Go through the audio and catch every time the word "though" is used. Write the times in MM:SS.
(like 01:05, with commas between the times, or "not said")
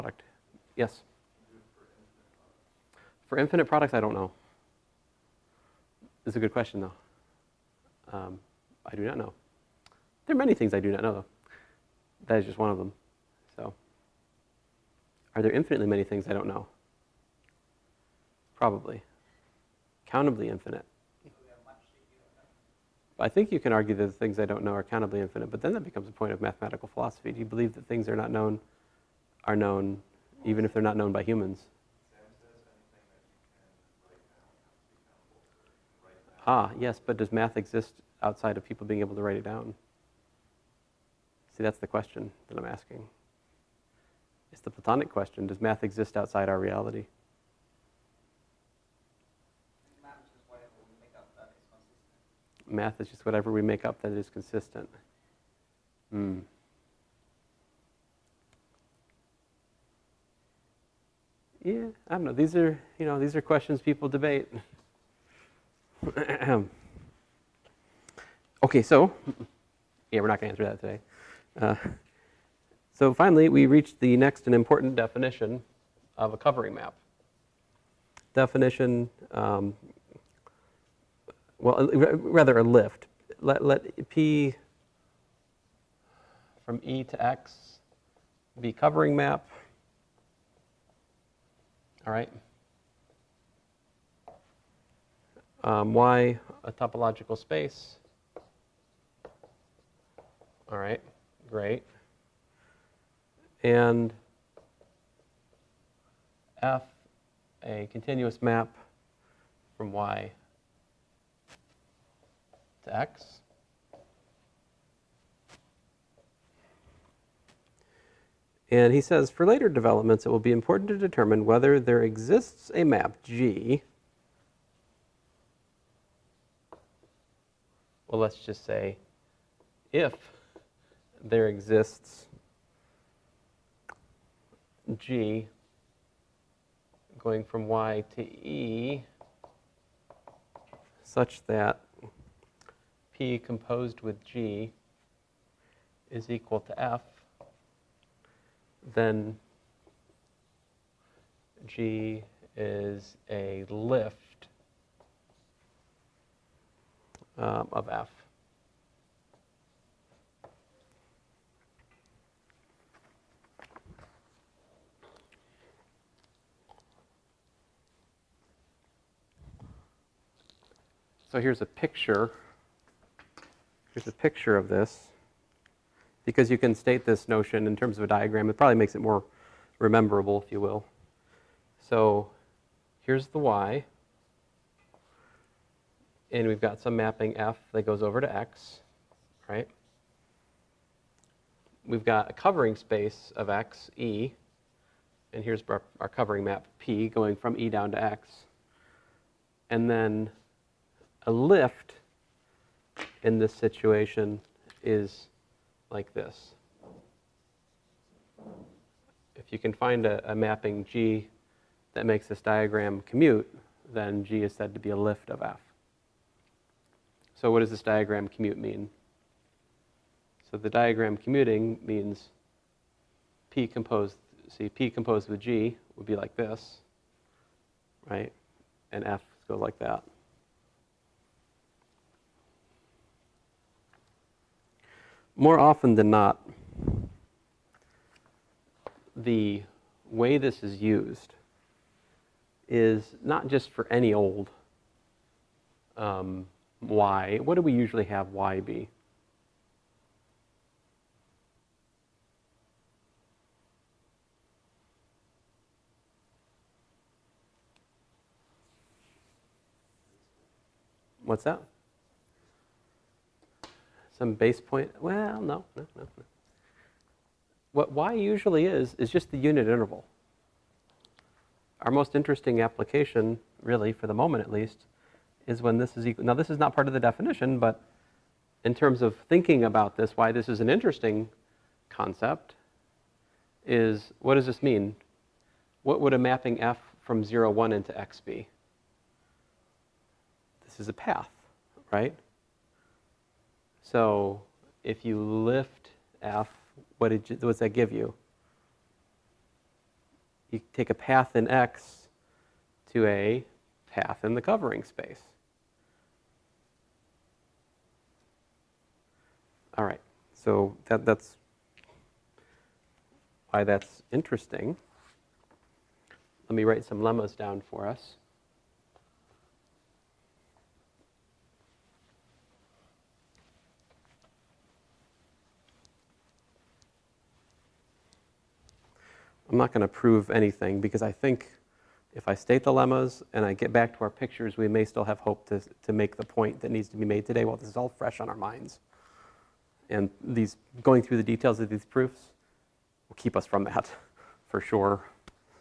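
00:06, 00:11.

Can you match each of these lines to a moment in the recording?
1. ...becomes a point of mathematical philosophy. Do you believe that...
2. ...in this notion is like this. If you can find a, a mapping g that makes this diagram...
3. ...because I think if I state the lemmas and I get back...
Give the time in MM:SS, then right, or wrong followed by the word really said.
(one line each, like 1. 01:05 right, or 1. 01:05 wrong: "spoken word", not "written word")
1. 00:25 right
2. 03:23 wrong: "situation", not "notion"
3. 05:30 right.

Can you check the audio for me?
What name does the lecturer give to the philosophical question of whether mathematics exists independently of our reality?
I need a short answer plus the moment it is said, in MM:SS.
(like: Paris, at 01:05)
The Platonic question, at 00:44.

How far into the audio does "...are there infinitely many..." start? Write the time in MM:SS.
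00:15.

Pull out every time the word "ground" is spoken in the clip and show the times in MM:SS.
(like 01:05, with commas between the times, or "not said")
not said.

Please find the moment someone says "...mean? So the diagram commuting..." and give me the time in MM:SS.
03:38.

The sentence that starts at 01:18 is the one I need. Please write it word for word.
Definition, um, well, uh, rather a lift.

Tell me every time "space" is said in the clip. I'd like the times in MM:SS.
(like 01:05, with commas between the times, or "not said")
01:37, 03:12, 05:04.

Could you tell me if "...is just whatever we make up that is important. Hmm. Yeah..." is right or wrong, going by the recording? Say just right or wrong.
wrong.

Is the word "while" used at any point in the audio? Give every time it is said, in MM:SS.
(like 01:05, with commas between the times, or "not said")
05:37.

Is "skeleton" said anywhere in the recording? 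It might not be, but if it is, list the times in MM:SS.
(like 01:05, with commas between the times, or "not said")
not said.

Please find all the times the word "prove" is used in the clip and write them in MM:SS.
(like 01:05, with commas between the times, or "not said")
05:29.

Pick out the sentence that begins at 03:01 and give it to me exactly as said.
So here's the y and we've got some mapping f that goes over to x, right?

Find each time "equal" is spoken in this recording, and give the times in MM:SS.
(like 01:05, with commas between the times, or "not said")
02:26, 04:36.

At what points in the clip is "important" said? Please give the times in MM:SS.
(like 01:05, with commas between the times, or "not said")
01:14, 02:00.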